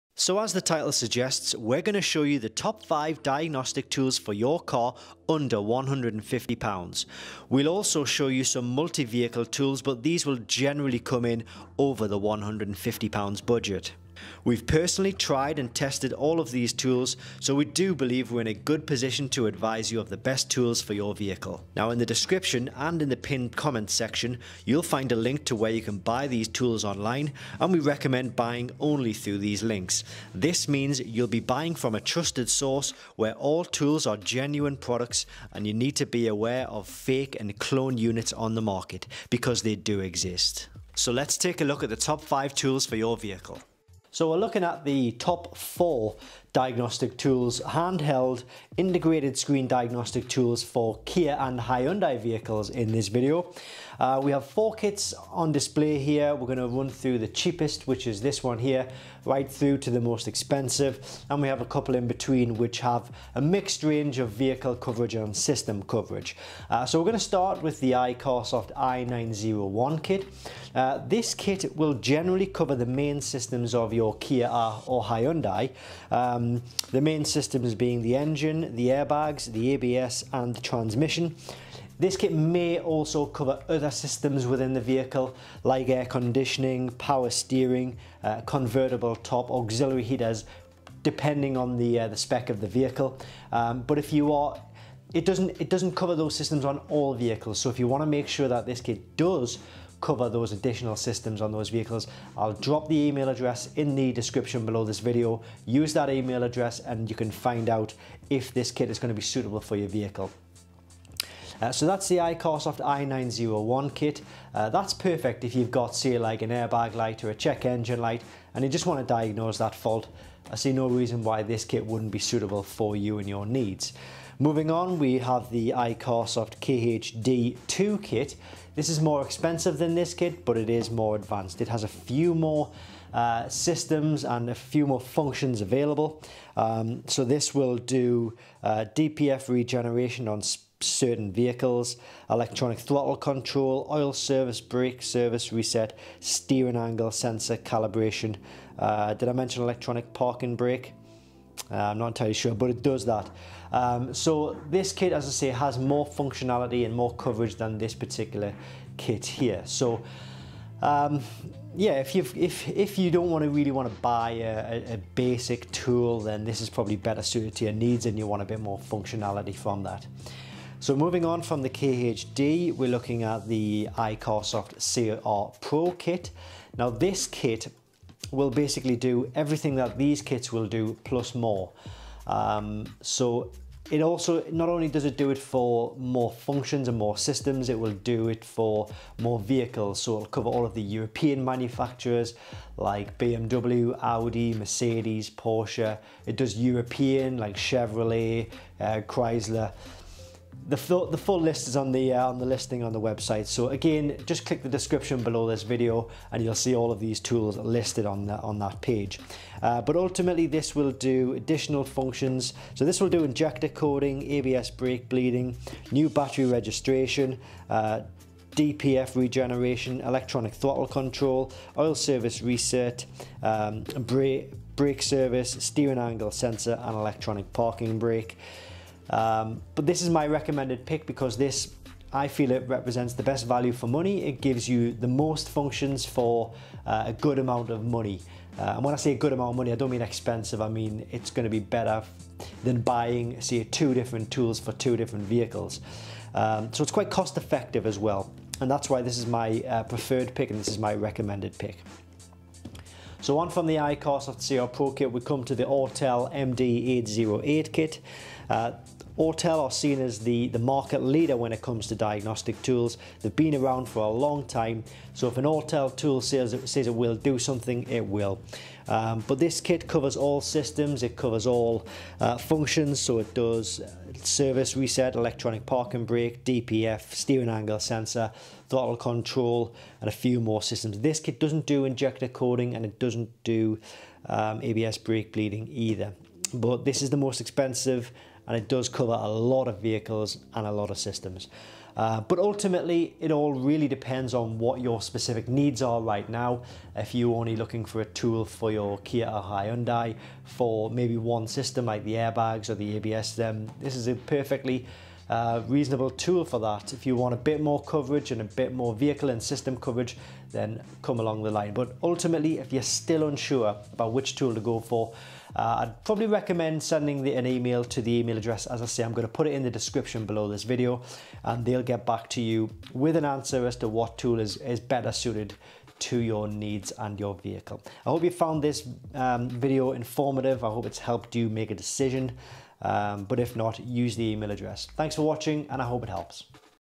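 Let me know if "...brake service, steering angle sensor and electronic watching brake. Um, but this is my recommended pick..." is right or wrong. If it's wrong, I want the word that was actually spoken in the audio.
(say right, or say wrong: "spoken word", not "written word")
wrong: "parking", not "watching".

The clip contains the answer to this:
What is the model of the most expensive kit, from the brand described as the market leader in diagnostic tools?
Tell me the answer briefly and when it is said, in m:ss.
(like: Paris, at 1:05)
Autel MD808, at 4:15.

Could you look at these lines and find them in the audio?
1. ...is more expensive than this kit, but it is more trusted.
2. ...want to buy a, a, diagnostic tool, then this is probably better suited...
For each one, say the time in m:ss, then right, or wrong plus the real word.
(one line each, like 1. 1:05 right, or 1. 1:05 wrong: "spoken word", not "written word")
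1. 2:08 wrong: "advanced", not "trusted"
2. 2:43 wrong: "basic", not "diagnostic".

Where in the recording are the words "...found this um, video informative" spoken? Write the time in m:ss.
5:28.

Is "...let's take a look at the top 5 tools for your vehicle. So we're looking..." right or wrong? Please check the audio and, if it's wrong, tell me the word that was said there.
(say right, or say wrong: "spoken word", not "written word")
right.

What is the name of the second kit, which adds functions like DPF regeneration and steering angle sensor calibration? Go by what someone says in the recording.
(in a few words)
iCarsoft KHD2.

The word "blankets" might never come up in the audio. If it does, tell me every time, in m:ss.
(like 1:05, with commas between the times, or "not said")
not said.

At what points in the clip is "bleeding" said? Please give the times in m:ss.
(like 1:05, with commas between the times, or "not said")
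3:35, 4:45.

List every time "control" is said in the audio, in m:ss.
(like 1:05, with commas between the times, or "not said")
2:23, 3:40, 4:38.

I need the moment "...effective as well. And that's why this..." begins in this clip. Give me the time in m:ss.
4:07.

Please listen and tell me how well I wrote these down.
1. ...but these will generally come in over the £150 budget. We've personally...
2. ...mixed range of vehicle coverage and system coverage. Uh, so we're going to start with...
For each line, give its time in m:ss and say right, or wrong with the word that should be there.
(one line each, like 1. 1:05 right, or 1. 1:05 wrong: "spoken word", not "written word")
1. 0:09 right
2. 1:03 right.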